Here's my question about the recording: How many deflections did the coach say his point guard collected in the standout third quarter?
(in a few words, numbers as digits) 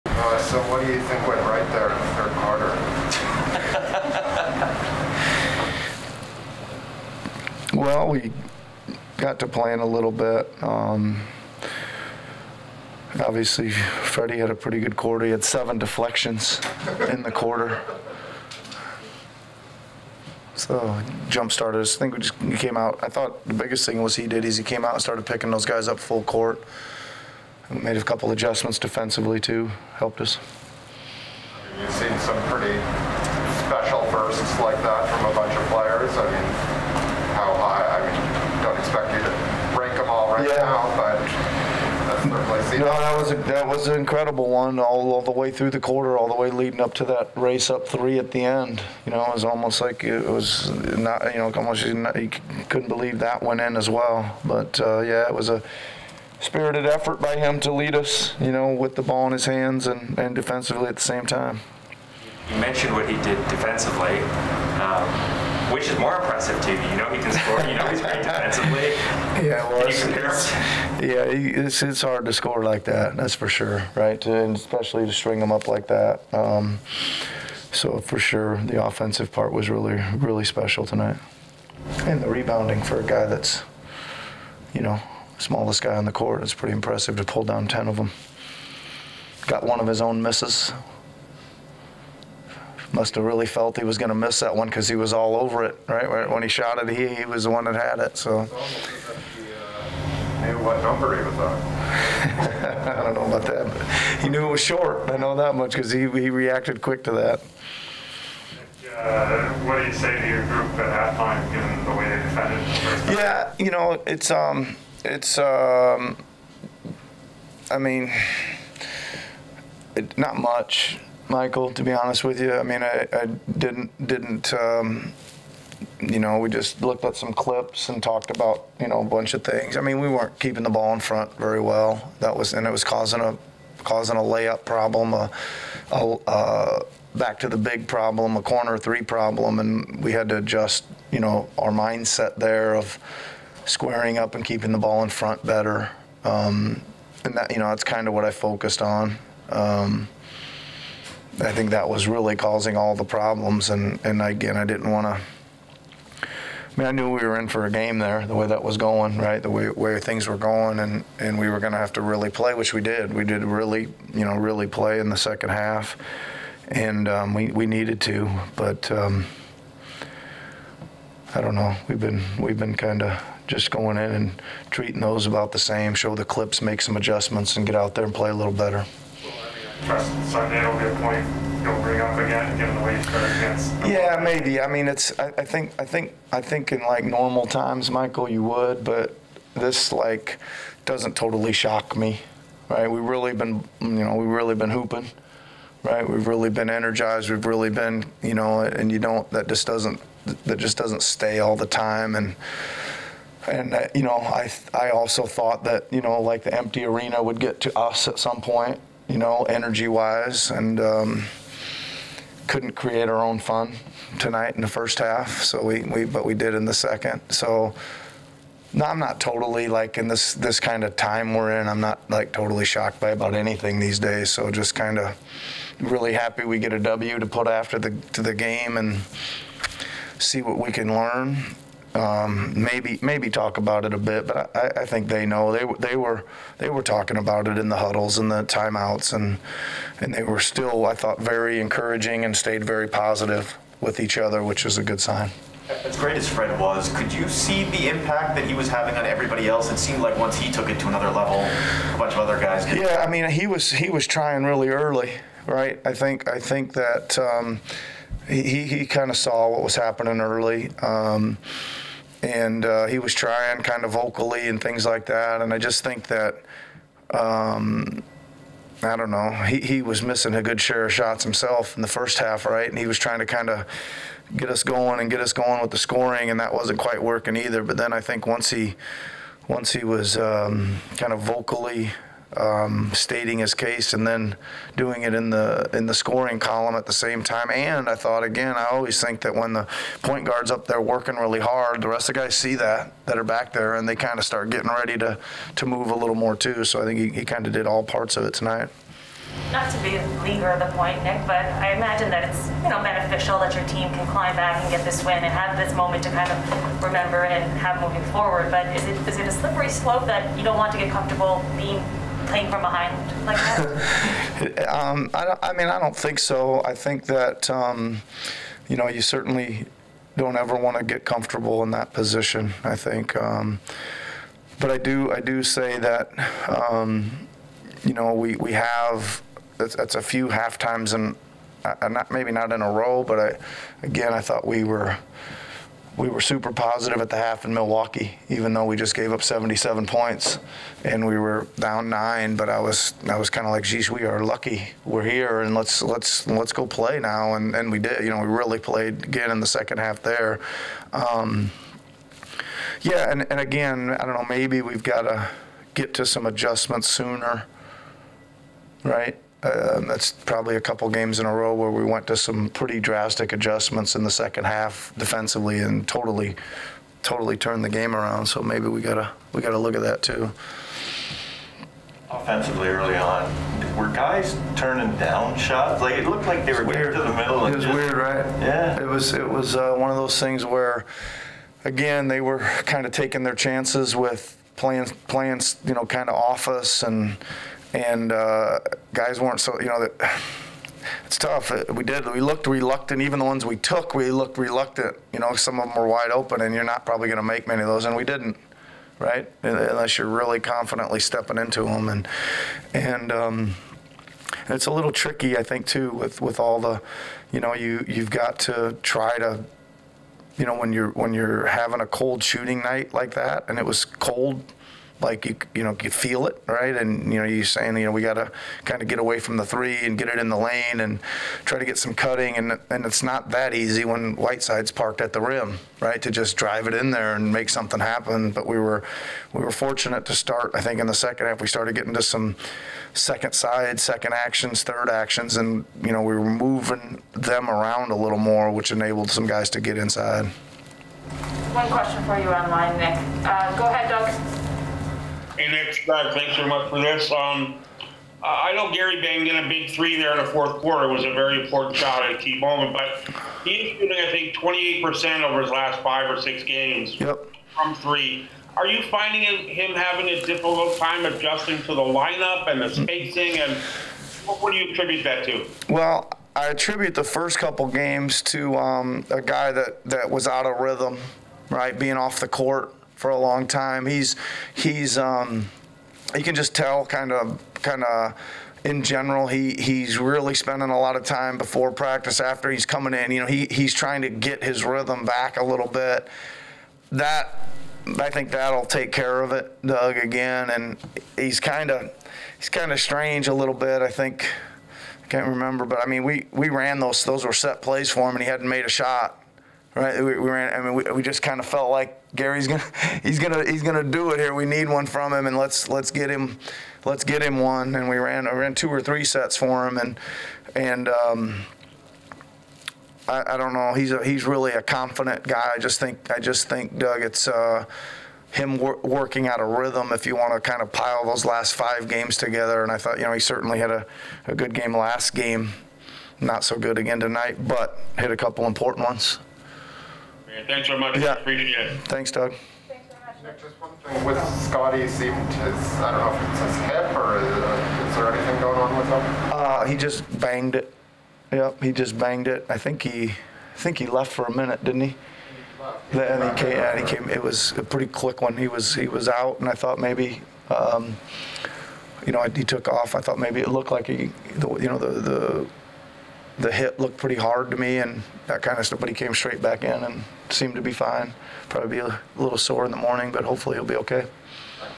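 7.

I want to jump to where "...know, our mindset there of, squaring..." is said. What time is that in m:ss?
2:21.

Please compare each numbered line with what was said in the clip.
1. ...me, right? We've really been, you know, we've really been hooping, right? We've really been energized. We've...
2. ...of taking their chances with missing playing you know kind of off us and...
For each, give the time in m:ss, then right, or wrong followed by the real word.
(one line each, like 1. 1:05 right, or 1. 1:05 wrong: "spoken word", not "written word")
1. 3:11 right
2. 6:22 wrong: "playing", not "missing".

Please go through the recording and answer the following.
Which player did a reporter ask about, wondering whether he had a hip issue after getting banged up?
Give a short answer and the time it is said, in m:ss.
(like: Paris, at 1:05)
Scotty, at 8:54.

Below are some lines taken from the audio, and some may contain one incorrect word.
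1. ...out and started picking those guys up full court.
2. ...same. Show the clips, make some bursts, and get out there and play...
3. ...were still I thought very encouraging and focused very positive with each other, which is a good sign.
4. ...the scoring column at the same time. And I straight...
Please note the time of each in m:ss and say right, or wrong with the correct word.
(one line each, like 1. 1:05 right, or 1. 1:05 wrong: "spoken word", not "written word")
1. 0:24 right
2. 2:55 wrong: "adjustments", not "bursts"
3. 4:00 wrong: "stayed", not "focused"
4. 4:45 wrong: "thought", not "straight".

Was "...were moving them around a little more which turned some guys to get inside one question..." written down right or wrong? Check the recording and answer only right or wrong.
wrong.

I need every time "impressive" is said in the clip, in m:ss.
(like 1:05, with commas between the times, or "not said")
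1:06, 1:26.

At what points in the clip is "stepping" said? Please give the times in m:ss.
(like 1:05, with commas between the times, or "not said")
6:40.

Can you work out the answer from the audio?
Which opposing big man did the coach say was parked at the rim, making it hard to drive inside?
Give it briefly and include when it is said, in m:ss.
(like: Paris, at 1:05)
Whiteside, at 7:04.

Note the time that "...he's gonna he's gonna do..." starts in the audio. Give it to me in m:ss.
8:23.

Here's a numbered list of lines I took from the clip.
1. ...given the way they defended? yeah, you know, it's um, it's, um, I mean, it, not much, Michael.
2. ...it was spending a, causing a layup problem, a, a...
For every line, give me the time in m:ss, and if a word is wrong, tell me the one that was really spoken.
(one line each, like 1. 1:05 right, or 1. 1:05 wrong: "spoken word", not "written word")
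1. 1:51 right
2. 2:12 wrong: "causing", not "spending".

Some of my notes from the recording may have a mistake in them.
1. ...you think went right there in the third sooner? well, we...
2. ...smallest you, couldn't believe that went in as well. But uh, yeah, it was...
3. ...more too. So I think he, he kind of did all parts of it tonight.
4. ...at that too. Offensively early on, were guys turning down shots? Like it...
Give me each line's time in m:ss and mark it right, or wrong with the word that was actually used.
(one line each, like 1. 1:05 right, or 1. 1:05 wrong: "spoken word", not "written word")
1. 0:00 wrong: "quarter", not "sooner"
2. 0:51 wrong: "almost", not "smallest"
3. 4:56 right
4. 6:09 right.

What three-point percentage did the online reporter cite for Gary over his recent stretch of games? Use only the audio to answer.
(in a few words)
28%.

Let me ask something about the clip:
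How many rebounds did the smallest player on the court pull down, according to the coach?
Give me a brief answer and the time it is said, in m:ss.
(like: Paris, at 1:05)
10, at 1:27.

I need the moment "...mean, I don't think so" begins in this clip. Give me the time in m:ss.
5:15.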